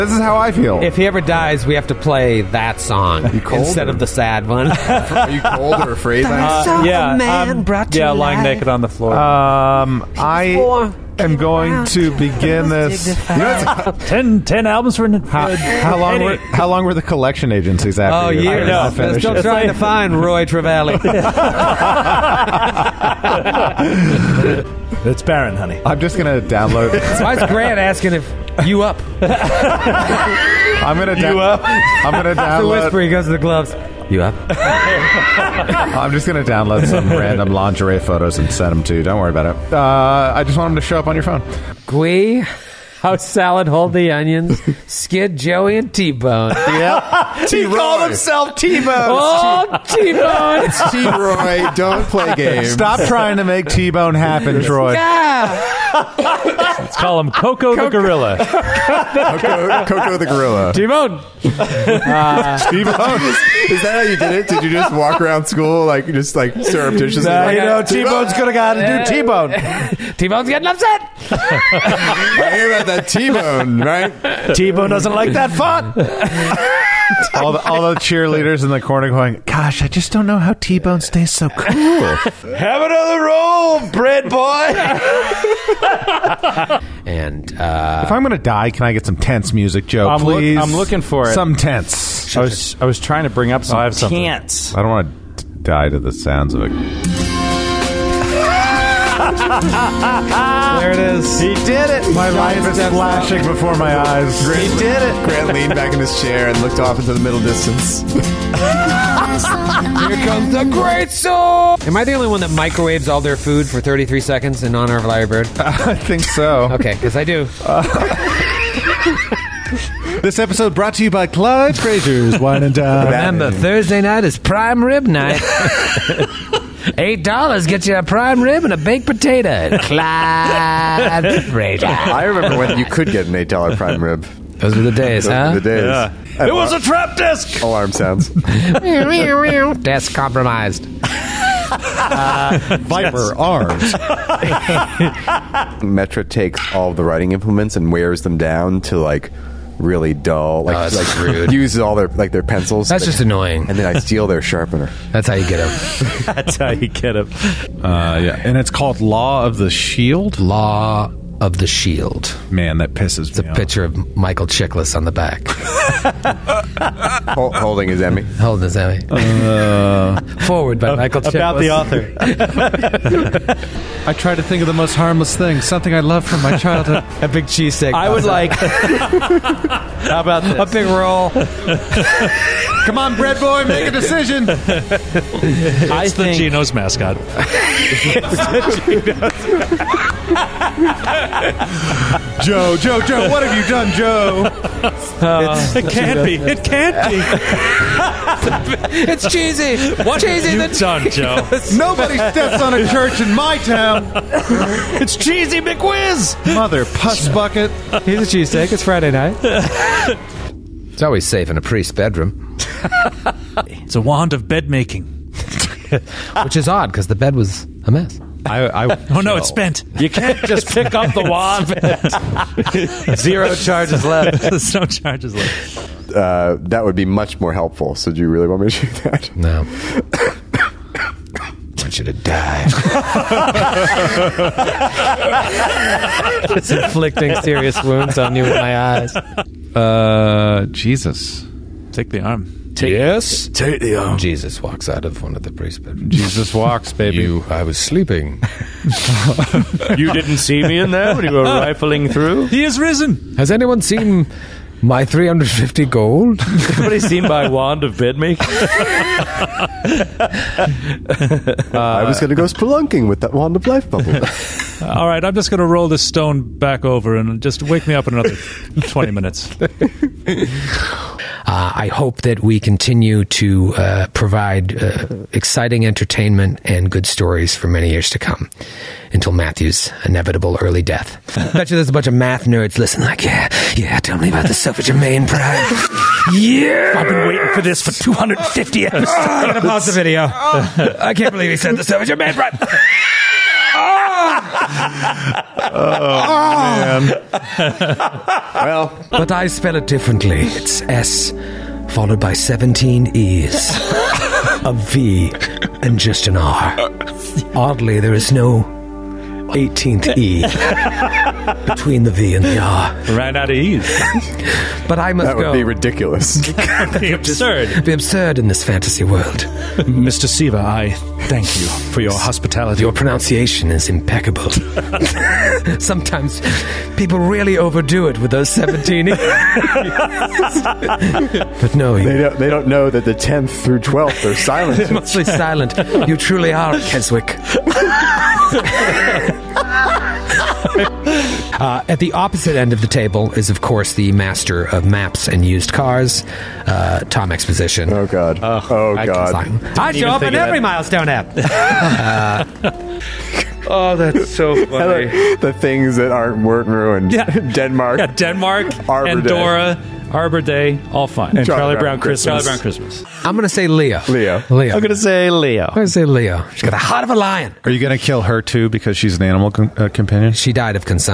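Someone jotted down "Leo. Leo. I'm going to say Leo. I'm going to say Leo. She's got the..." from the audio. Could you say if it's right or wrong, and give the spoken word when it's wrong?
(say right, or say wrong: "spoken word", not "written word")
right.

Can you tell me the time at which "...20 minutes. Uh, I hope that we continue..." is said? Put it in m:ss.
4:28.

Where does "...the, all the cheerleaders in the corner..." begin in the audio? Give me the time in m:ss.
1:17.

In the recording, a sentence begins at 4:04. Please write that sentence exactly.
Jesus walks out of one of the priest's bedrooms.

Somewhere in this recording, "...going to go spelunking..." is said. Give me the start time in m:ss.
4:22.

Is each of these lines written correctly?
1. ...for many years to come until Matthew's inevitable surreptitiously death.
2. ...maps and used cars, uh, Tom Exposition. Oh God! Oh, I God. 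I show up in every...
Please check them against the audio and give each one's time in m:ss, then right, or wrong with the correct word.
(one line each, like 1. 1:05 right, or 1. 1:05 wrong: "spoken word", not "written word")
1. 4:37 wrong: "early", not "surreptitiously"
2. 5:44 right.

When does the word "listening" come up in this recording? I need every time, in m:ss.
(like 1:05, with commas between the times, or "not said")
4:42.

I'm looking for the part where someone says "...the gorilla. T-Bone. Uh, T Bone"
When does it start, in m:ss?
1:00.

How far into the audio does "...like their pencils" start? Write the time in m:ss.
2:32.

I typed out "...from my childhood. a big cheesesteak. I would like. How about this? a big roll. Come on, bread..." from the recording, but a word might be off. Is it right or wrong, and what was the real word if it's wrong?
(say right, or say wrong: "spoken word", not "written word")
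right.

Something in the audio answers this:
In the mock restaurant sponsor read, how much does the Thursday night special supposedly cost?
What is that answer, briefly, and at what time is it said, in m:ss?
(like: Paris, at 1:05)
$8, at 2:06.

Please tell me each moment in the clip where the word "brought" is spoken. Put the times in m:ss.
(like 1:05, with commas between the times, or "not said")
0:07, 2:00.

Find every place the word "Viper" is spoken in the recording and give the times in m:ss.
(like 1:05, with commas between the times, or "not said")
2:22.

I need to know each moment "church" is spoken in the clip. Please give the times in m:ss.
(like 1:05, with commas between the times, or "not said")
3:22.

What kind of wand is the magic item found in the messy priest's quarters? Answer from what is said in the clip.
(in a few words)
bed making.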